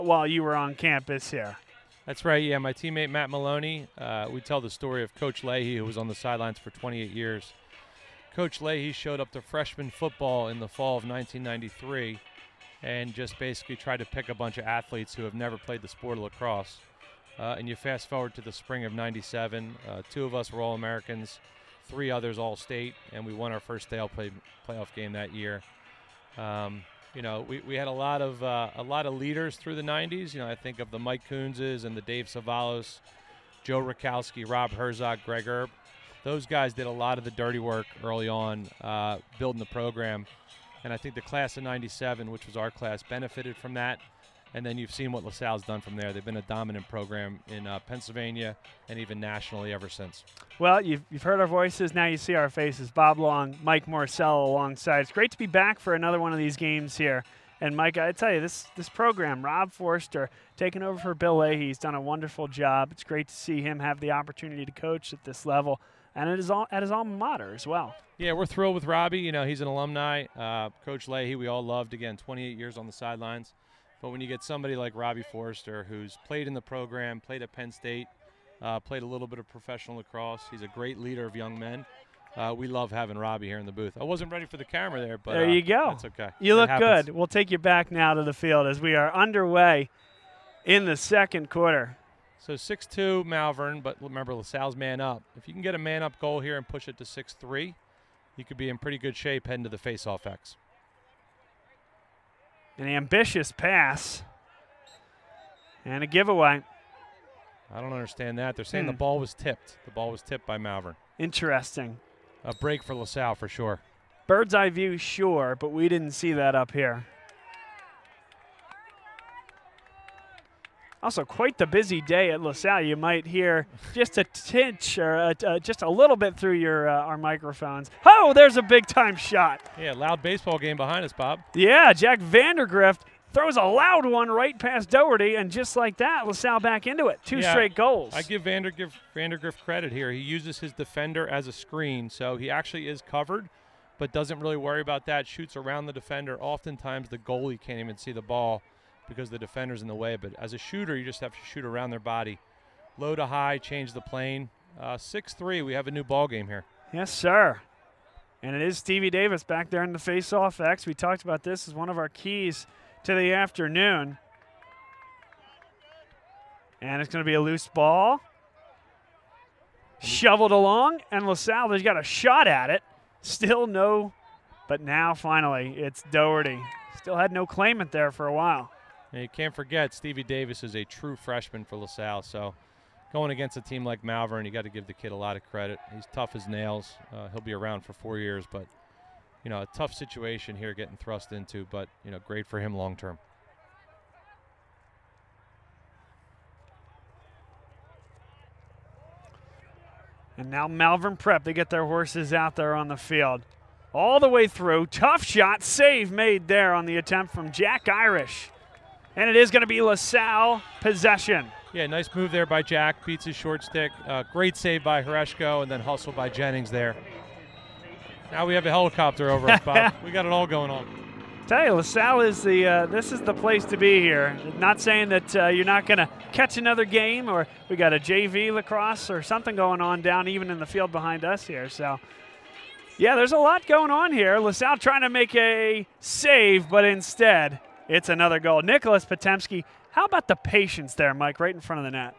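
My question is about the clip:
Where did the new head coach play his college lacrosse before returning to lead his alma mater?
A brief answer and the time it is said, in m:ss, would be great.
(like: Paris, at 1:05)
Penn State, at 1:17.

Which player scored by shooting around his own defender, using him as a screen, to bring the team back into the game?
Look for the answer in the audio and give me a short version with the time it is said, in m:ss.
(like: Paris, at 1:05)
Jack Vandergrift, at 2:11.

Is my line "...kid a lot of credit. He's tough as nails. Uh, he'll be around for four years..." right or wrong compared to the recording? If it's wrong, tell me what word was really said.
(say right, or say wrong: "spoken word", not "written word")
right.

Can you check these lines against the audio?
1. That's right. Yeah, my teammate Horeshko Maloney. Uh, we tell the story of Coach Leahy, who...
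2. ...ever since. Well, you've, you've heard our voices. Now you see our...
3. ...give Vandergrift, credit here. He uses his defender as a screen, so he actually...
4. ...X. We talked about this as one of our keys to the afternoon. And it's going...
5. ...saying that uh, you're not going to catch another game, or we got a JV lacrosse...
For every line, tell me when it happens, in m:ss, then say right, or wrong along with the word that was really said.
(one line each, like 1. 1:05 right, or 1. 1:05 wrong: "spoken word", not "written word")
1. 0:02 wrong: "Matt", not "Horeshko"
2. 0:49 right
3. 2:18 right
4. 2:40 right
5. 3:44 right.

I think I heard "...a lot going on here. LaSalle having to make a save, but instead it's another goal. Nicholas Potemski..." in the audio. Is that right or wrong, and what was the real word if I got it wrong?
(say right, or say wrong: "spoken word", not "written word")
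wrong: "trying", not "having".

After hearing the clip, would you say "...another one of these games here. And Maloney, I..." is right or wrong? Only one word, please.
wrong.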